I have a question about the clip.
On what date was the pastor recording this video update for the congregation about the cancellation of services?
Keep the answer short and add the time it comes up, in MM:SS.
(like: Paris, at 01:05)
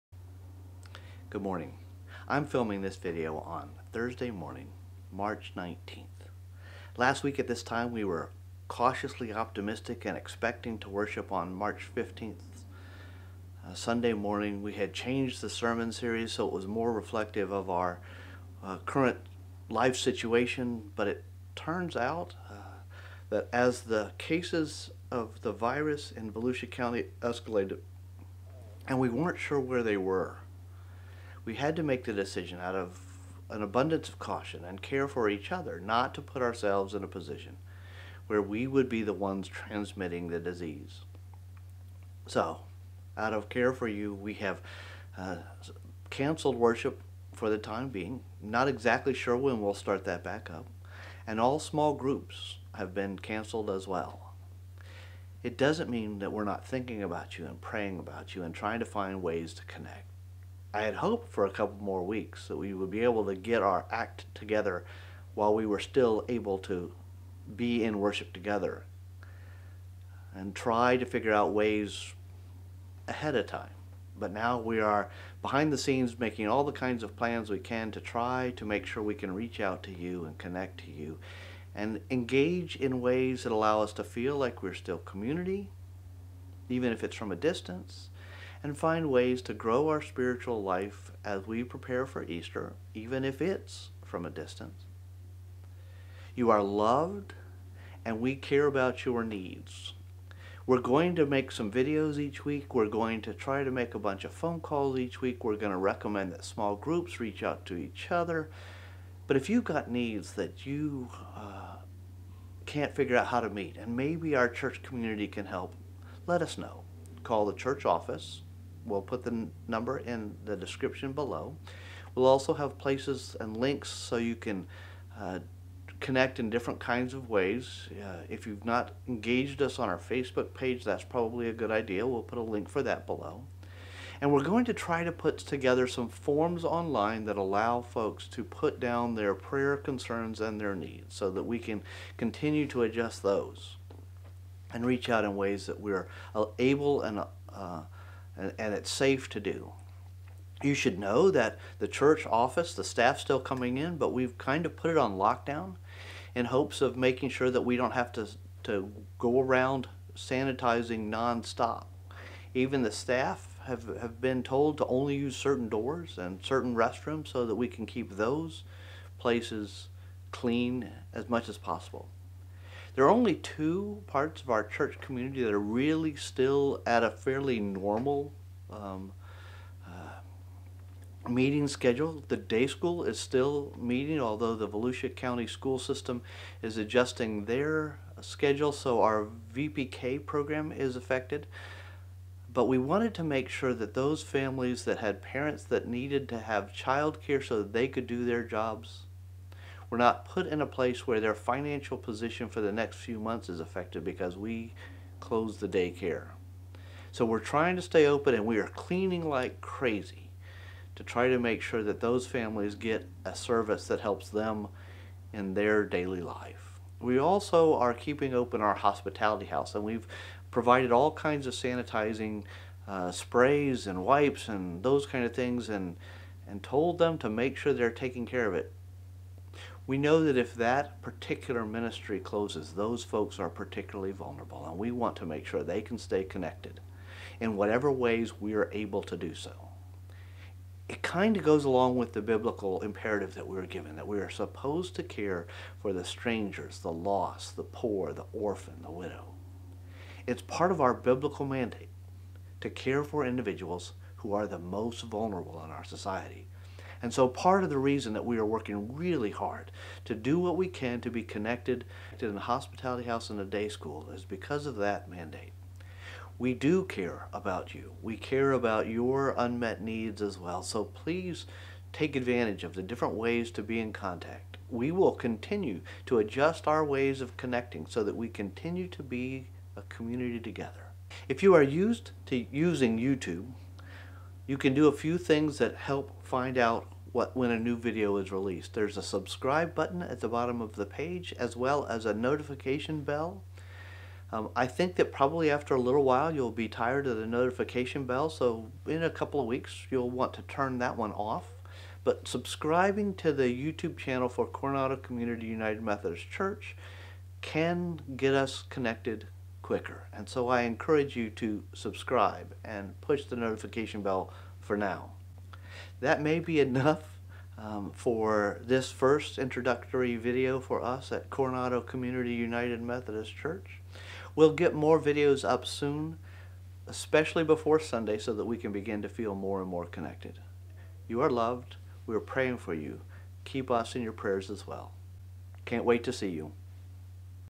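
March 19th, at 00:05.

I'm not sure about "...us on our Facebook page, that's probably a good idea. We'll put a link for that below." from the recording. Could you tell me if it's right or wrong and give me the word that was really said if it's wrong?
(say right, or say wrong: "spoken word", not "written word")
right.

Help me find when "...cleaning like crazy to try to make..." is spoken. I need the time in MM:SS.
03:28.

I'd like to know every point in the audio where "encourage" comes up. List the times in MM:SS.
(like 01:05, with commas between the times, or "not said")
05:10.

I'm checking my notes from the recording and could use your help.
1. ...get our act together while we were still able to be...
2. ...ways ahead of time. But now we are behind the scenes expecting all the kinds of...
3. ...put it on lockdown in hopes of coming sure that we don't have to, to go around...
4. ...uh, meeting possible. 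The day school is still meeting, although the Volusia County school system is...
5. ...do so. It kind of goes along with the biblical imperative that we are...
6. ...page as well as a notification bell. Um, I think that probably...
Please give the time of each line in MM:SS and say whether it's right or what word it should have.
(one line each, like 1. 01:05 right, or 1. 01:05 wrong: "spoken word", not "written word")
1. 01:03 right
2. 01:11 wrong: "making", not "expecting"
3. 02:34 wrong: "making", not "coming"
4. 02:59 wrong: "schedule", not "possible"
5. 03:59 right
6. 04:50 right.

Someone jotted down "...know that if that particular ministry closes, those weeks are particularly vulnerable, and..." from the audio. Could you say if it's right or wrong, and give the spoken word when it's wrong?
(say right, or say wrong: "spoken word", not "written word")
wrong: "folks", not "weeks".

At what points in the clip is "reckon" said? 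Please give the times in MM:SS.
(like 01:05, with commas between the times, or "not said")
not said.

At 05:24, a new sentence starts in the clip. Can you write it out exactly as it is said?
We'll get more videos up soon, especially before Sunday, so that we can begin to feel more and more connected.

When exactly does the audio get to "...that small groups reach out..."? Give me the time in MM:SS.
01:46.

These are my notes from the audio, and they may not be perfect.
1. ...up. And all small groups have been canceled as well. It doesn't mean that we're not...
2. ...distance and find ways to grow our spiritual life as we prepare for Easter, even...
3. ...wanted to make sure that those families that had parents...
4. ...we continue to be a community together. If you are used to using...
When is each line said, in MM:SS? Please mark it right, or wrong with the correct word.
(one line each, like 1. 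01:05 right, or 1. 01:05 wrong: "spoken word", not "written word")
1. 00:50 right
2. 01:27 right
3. 03:12 right
4. 04:38 right.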